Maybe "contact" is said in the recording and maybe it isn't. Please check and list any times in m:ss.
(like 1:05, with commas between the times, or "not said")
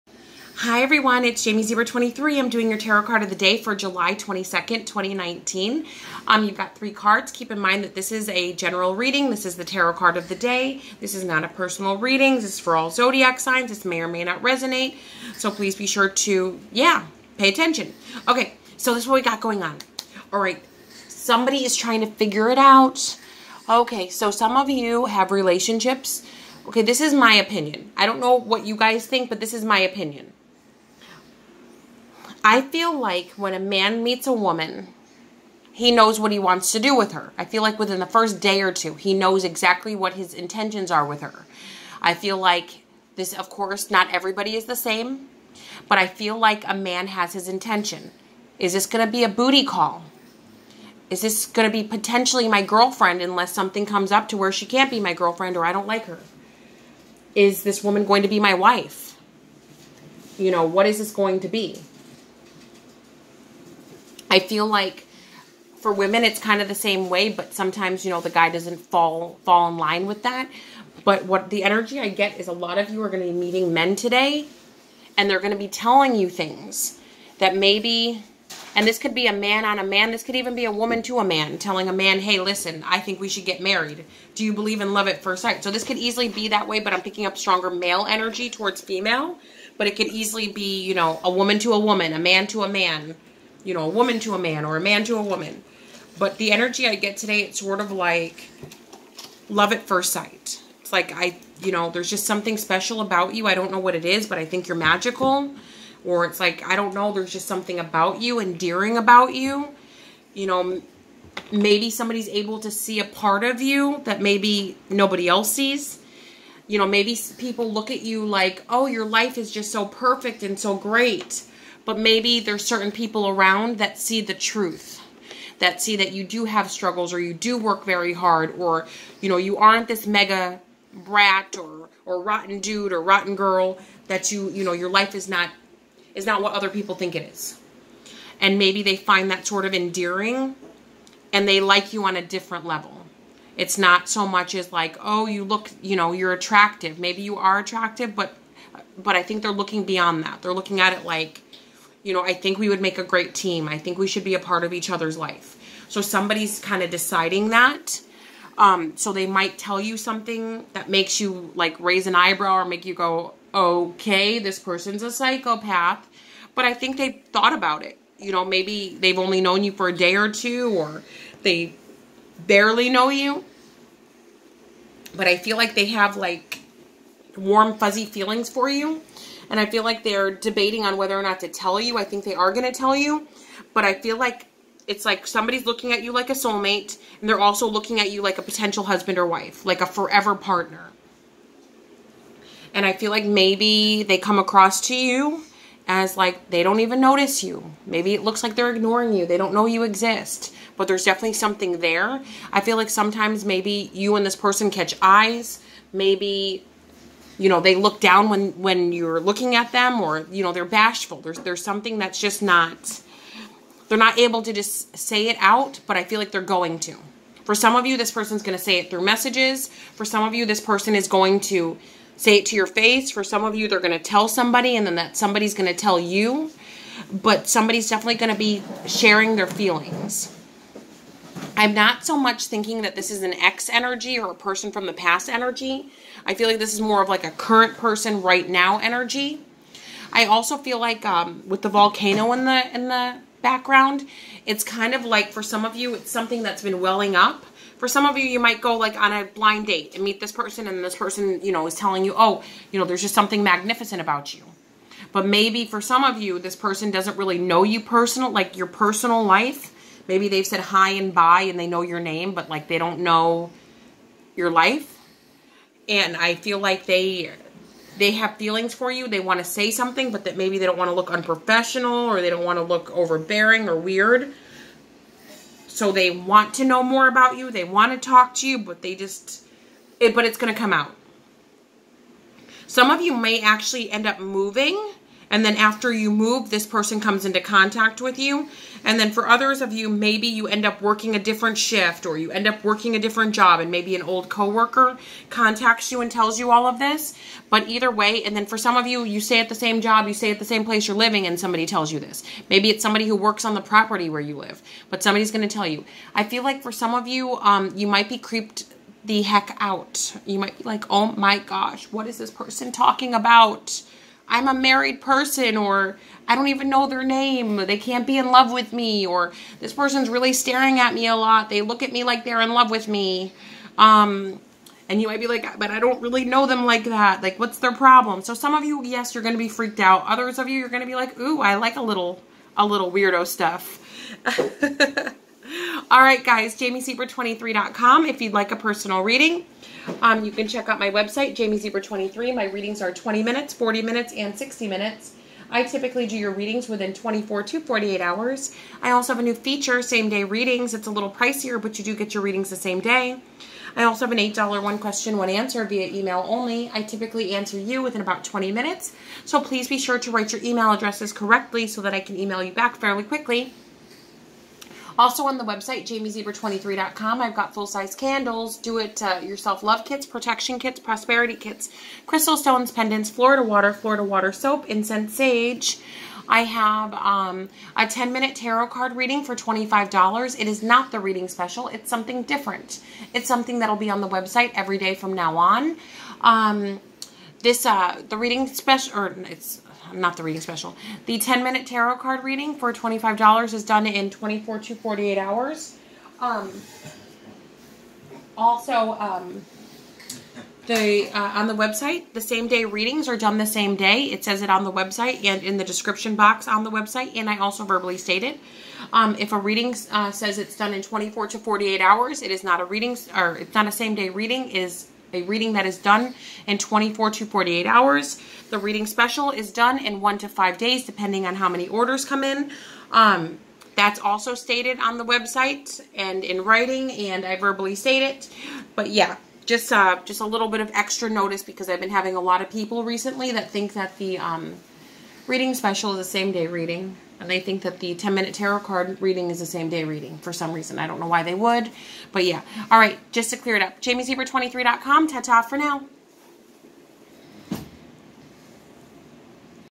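4:47, 4:55.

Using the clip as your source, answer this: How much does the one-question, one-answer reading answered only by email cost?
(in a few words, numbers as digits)
$8.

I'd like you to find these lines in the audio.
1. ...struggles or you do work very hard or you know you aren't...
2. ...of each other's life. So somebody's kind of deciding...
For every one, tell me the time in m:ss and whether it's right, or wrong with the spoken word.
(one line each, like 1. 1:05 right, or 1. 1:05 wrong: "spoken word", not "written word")
1. 2:06 right
2. 2:34 right.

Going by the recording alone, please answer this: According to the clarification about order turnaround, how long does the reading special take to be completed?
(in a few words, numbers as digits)
1 to 5 days.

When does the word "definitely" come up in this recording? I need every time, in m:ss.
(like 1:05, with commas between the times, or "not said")
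3:21, 3:47.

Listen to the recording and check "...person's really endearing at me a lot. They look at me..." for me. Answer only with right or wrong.
wrong.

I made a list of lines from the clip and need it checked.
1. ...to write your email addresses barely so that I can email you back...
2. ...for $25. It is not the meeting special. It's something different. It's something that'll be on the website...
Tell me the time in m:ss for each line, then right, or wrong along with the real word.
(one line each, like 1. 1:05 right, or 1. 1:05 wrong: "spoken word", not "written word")
1. 5:59 wrong: "correctly", not "barely"
2. 6:19 wrong: "reading", not "meeting".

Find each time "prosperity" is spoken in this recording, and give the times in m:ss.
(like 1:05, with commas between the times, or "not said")
6:10.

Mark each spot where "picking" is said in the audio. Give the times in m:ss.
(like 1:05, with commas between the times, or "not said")
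1:27.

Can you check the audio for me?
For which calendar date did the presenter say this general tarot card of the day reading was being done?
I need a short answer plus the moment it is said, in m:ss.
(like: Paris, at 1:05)
July 22, 2019, at 0:03.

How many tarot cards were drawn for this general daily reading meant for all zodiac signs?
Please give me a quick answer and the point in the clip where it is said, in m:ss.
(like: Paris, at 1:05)
3, at 0:06.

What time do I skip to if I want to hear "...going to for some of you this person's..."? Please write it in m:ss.
3:36.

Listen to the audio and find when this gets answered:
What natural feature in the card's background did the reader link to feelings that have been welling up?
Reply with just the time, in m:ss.
4:01.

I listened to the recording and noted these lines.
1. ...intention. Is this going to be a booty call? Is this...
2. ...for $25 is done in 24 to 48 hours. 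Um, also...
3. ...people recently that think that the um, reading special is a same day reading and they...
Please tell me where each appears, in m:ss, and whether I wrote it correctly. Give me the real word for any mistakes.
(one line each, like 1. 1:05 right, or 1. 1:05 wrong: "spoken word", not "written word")
1. 0:47 right
2. 6:32 right
3. 7:12 right.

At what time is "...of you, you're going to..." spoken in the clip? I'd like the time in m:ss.
5:30.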